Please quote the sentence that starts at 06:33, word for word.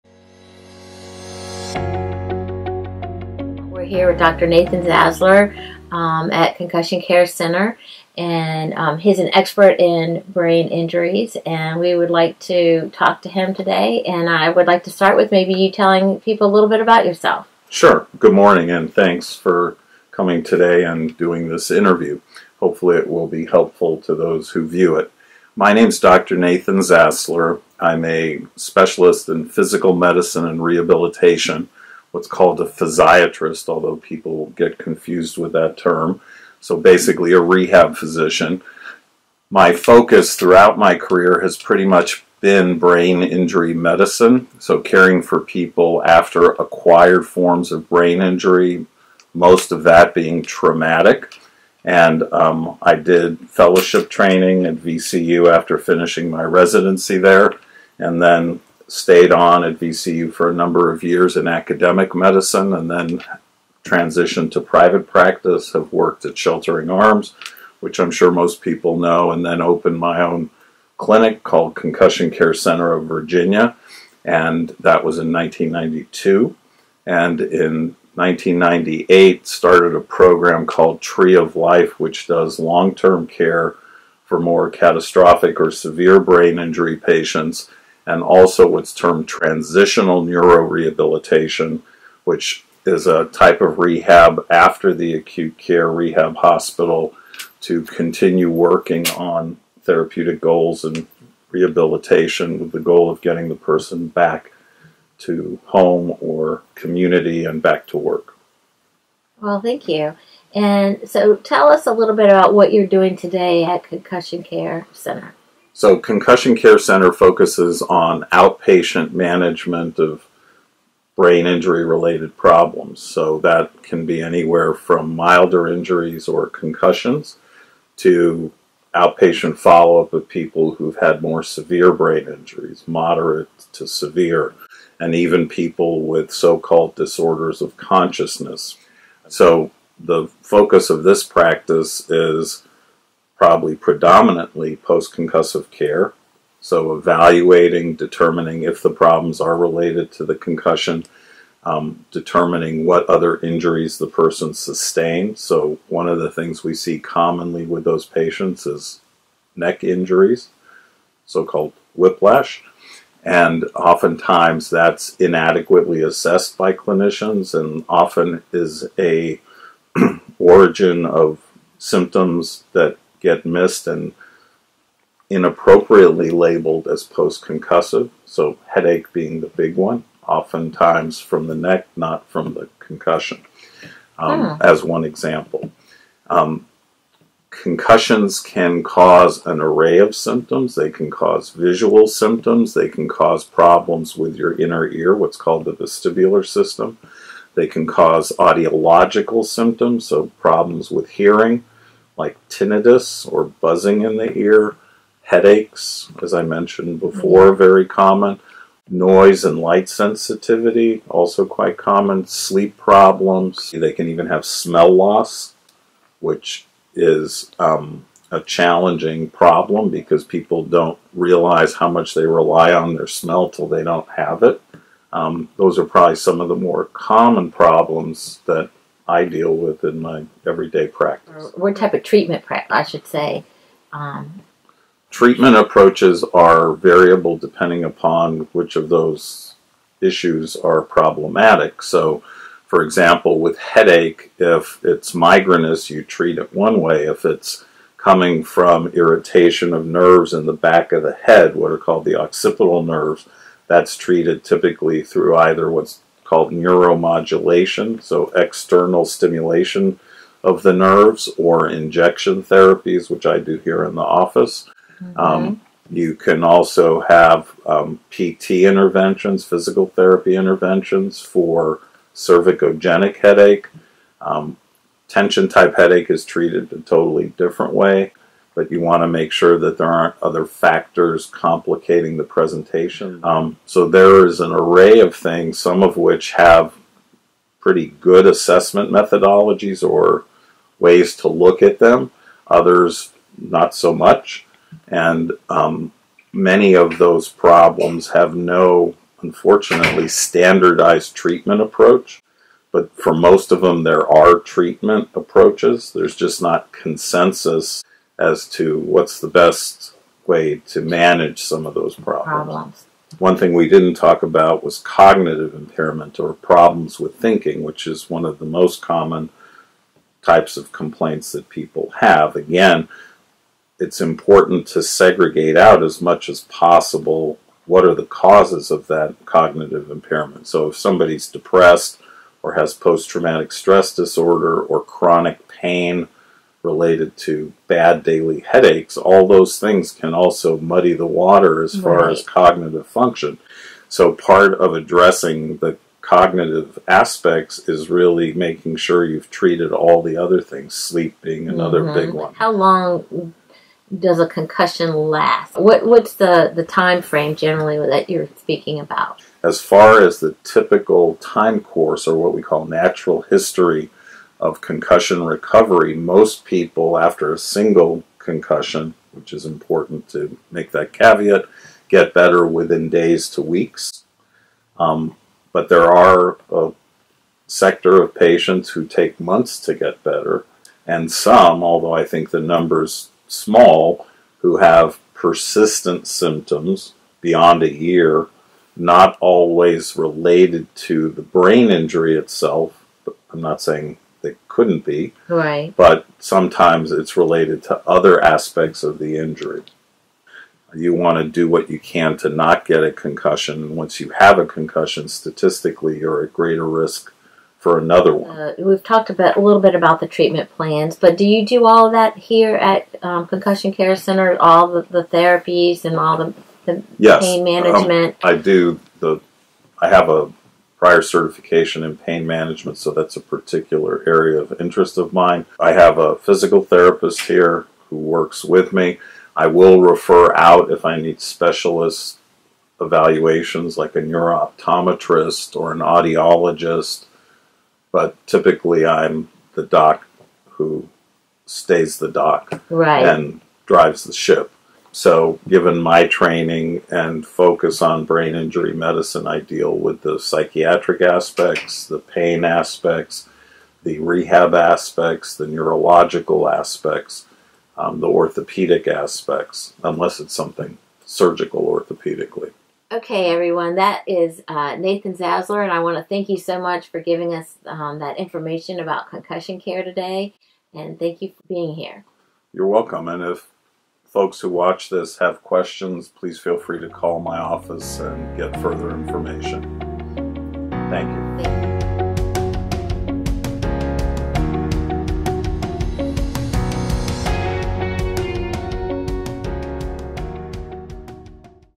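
I'm not saying they couldn't be.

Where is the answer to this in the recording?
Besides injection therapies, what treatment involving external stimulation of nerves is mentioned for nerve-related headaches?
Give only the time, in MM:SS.
04:16.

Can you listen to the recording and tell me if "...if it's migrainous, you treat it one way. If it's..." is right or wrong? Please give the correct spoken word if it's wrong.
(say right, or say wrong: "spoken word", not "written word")
right.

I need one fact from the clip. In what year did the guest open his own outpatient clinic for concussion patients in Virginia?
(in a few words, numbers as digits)
1992.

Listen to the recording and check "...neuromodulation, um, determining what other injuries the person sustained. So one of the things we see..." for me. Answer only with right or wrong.
wrong.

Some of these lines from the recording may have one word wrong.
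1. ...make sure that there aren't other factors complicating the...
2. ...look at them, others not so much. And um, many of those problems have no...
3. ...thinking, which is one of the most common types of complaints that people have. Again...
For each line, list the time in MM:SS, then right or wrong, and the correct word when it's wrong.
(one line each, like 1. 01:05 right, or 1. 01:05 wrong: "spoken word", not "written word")
1. 04:39 right
2. 04:51 right
3. 05:17 right.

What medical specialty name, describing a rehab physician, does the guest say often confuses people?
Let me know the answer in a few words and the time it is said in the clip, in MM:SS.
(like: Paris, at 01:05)
Physiatrist, at 00:32.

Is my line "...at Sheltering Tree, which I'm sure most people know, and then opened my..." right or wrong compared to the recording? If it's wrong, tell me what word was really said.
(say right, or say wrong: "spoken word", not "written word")
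wrong: "Arms", not "Tree".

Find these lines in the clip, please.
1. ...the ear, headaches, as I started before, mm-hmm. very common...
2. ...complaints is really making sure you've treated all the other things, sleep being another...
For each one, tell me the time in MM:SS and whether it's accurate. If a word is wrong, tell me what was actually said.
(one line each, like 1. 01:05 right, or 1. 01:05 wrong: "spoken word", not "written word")
1. 03:24 wrong: "mentioned", not "started"
2. 05:46 wrong: "aspects", not "complaints".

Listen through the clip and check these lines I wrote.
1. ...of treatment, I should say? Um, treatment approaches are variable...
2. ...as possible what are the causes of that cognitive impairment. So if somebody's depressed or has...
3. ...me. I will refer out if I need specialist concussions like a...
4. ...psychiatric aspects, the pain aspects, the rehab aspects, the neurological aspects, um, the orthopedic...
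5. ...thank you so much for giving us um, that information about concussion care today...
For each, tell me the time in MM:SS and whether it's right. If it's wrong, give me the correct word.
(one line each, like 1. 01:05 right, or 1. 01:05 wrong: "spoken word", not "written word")
1. 03:51 right
2. 05:26 right
3. 07:08 wrong: "evaluations", not "concussions"
4. 07:30 right
5. 07:46 right.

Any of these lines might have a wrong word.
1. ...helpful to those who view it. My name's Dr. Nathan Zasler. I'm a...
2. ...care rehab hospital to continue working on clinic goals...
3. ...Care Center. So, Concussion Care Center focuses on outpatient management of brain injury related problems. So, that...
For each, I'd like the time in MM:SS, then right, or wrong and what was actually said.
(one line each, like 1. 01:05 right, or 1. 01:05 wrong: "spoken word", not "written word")
1. 00:23 right
2. 01:35 wrong: "therapeutic", not "clinic"
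3. 01:54 right.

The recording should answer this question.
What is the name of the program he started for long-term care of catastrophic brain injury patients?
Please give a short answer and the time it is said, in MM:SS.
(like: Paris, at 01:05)
Tree of Life, at 01:21.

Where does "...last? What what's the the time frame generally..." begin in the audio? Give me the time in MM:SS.
05:54.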